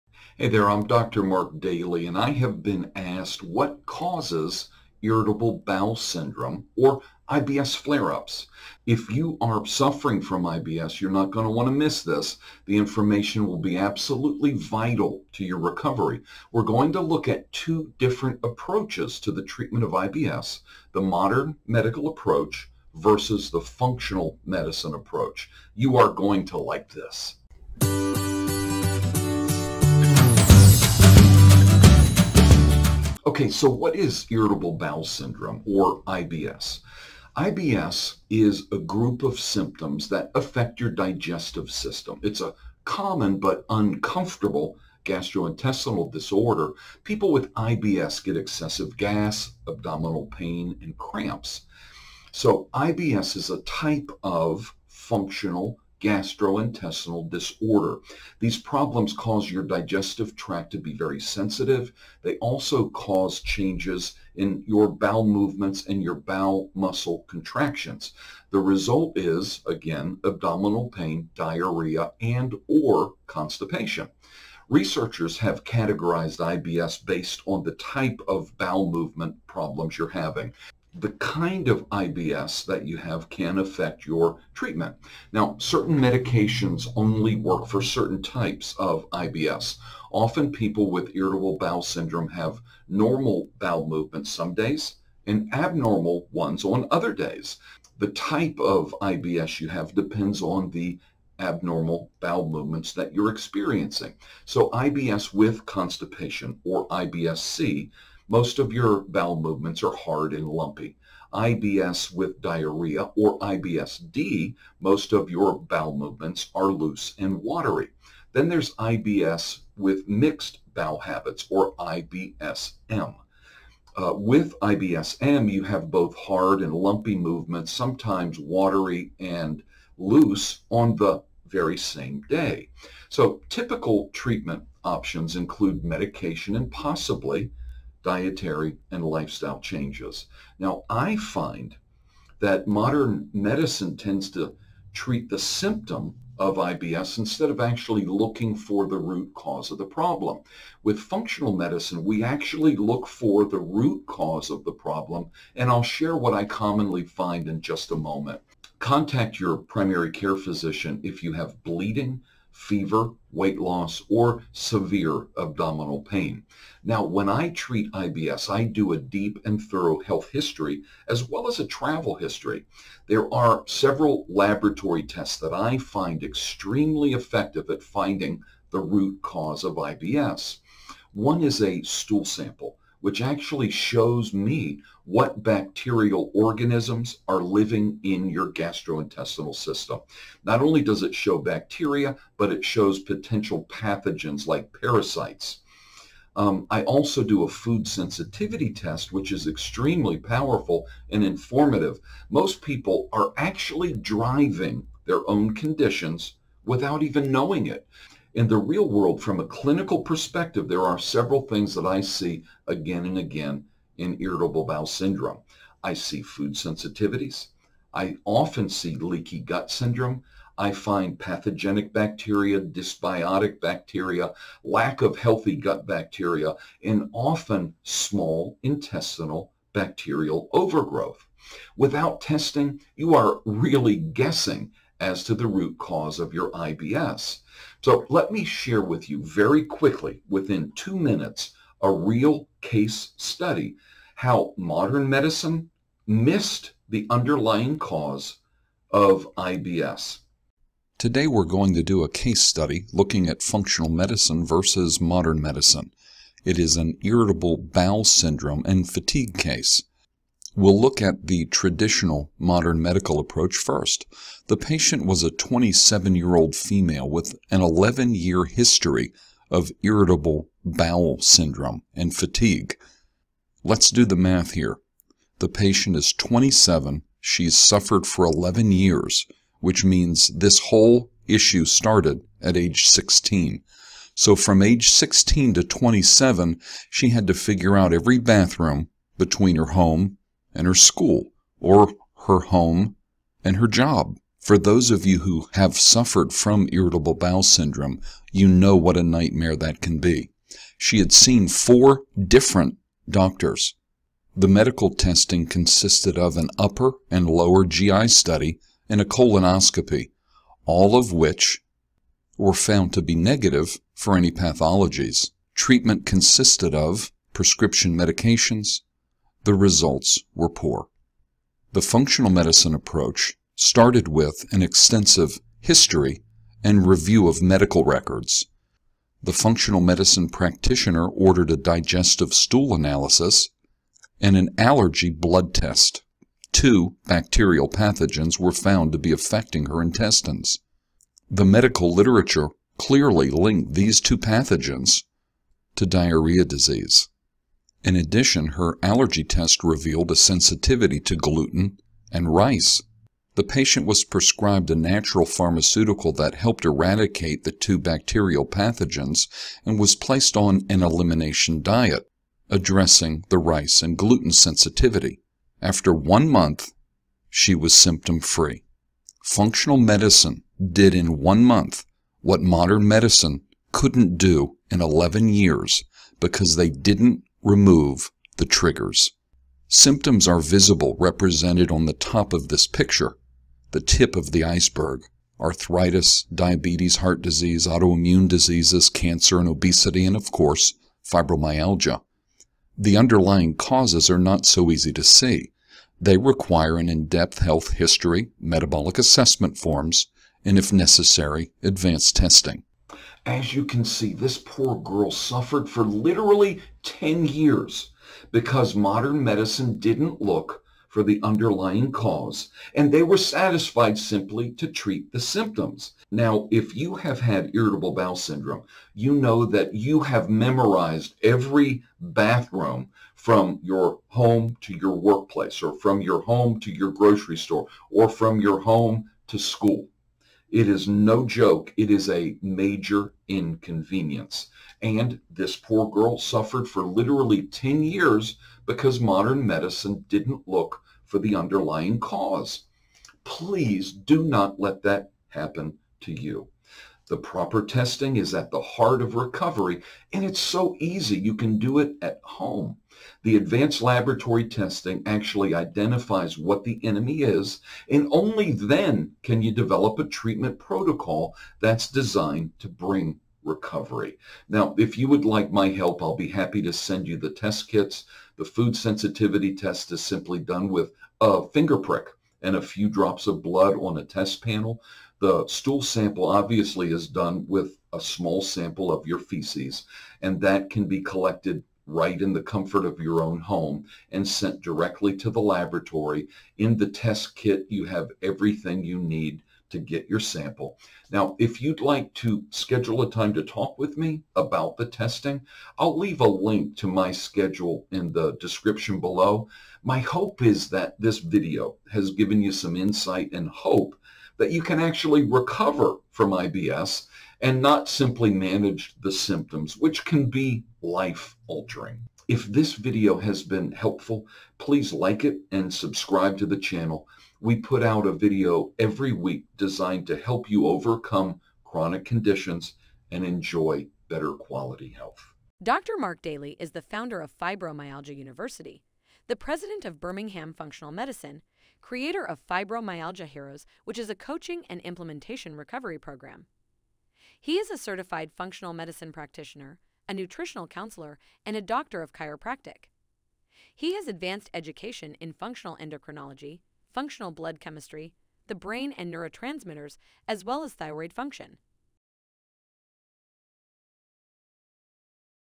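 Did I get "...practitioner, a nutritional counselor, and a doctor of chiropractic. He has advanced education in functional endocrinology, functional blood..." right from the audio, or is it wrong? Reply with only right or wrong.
right.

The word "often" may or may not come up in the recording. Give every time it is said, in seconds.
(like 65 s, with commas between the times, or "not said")
90 s, 218 s, 227 s.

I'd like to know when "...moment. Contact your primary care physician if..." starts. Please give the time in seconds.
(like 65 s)
157 s.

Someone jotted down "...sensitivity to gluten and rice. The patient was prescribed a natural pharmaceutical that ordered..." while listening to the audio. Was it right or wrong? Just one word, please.
wrong.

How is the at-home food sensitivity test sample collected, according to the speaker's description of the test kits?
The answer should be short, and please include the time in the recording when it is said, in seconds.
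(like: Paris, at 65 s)
A finger prick, at 471 s.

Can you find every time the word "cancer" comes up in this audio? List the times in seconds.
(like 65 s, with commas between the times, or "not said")
388 s.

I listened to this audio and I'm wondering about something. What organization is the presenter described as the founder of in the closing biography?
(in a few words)
Fibromyalgia University.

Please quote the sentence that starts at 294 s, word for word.
For those of you who have suffered from irritable bowel syndrome, you know what a nightmare that can be.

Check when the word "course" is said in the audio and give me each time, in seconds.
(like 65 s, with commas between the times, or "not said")
390 s.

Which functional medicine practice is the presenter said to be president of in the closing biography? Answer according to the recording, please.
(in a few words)
Birmingham Functional Medicine.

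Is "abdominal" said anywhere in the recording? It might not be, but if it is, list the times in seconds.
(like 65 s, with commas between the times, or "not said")
49 s, 70 s, 165 s.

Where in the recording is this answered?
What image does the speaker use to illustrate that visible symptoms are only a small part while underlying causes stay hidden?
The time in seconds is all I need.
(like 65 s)
383 s.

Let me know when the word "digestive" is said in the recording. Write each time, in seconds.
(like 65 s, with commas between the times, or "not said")
40 s, 59 s, 331 s.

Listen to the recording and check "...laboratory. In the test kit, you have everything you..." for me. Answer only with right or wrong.
right.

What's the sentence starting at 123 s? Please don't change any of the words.
Uh, with IBS-M, you have both hard and lumpy movements, sometimes watery and loose on the very same day.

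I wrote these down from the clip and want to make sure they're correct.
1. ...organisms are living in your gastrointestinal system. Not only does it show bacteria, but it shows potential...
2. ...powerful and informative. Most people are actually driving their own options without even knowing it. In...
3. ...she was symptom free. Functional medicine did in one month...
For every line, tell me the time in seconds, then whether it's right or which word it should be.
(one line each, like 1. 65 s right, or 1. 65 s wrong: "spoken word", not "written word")
1. 186 s right
2. 200 s wrong: "conditions", not "options"
3. 367 s right.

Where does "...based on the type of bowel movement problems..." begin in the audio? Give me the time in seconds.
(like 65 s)
77 s.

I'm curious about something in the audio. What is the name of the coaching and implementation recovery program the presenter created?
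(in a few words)
Fibromyalgia Heroes.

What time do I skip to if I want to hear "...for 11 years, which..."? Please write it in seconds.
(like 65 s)
278 s.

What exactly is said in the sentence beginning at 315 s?
Treatment consisted of prescription medications, the results were poor.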